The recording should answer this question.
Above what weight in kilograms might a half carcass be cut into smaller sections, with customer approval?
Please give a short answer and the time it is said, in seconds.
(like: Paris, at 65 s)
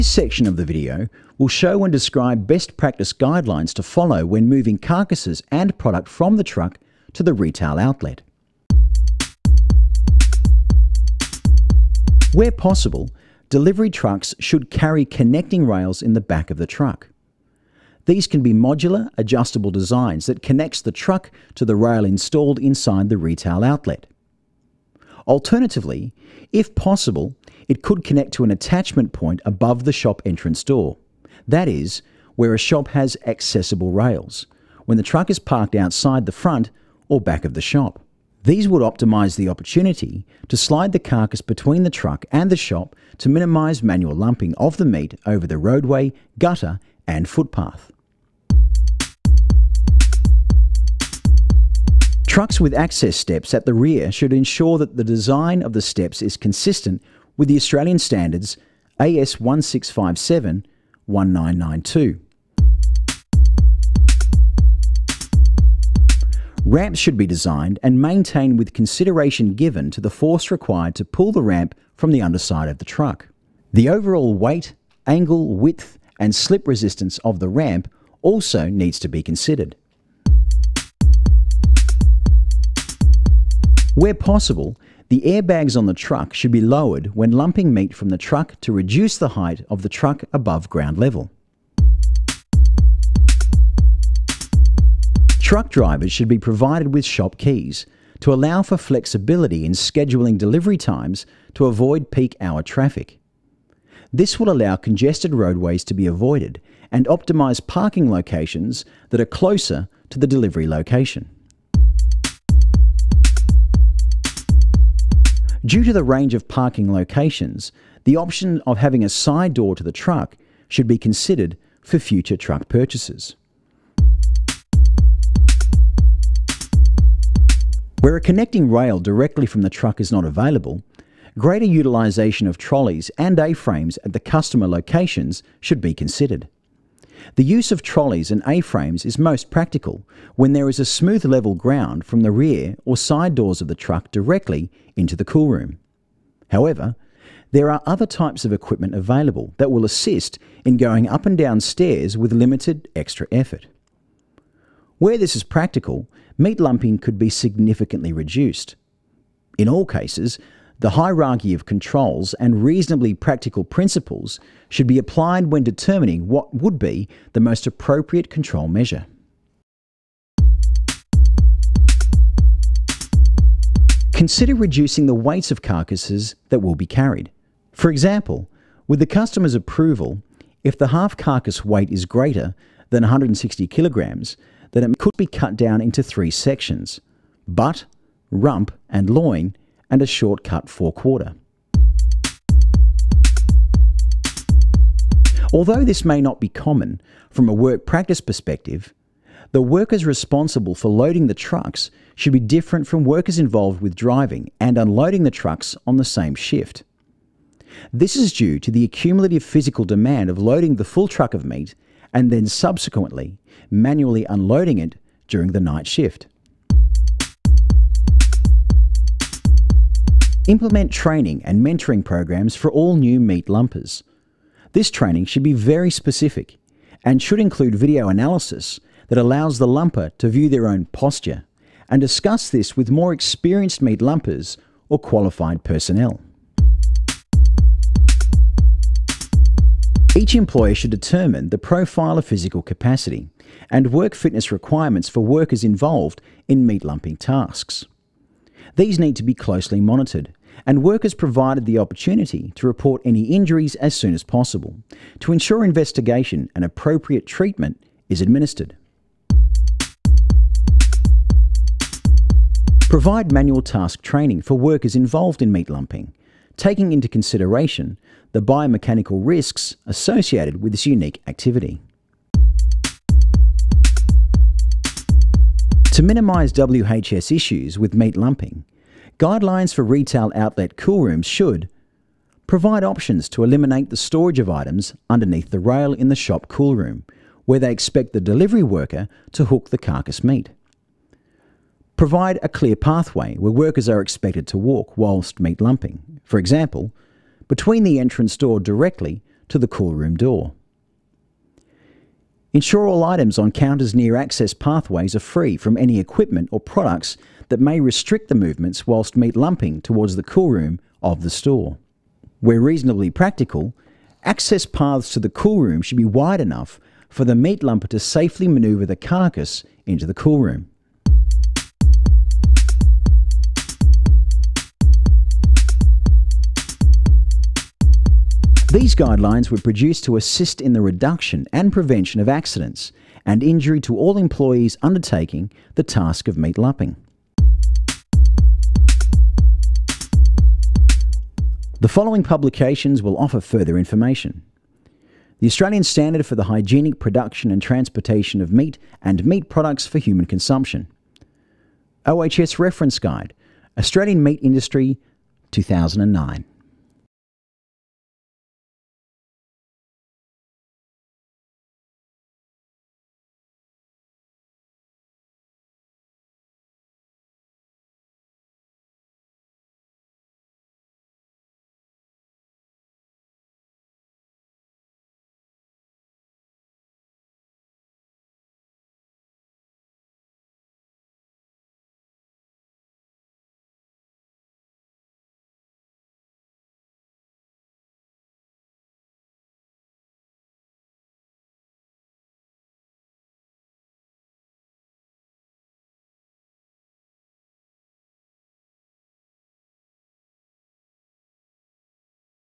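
160 kilograms, at 183 s.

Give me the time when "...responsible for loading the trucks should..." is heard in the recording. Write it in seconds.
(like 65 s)
200 s.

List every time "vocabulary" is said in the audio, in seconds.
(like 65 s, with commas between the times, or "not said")
not said.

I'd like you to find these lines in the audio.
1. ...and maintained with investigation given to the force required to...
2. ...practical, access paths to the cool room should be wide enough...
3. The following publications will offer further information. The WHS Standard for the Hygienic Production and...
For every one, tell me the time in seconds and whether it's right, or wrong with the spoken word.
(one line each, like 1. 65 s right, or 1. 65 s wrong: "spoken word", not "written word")
1. 67 s wrong: "consideration", not "investigation"
2. 313 s right
3. 341 s wrong: "Australian", not "WHS".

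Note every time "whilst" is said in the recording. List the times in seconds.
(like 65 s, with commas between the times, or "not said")
294 s, 308 s.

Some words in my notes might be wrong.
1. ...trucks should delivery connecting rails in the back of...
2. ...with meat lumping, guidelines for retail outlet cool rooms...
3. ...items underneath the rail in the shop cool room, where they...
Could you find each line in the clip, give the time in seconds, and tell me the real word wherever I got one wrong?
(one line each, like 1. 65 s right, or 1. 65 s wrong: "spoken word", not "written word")
1. 13 s wrong: "carry", not "delivery"
2. 277 s right
3. 284 s right.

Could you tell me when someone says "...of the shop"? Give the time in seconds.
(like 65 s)
37 s.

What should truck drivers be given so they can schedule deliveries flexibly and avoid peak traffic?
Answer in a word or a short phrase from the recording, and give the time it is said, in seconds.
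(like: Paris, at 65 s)
shop keys, at 97 s.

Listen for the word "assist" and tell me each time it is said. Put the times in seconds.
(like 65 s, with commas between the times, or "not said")
149 s, 330 s.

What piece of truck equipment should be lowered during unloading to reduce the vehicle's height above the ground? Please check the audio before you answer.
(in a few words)
airbags.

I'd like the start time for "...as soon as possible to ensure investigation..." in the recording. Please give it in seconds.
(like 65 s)
253 s.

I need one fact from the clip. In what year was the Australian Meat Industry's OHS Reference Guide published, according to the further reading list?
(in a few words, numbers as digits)
2009.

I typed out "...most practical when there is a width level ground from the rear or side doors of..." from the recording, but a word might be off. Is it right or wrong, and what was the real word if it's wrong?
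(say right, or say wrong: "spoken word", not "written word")
wrong: "smooth", not "width".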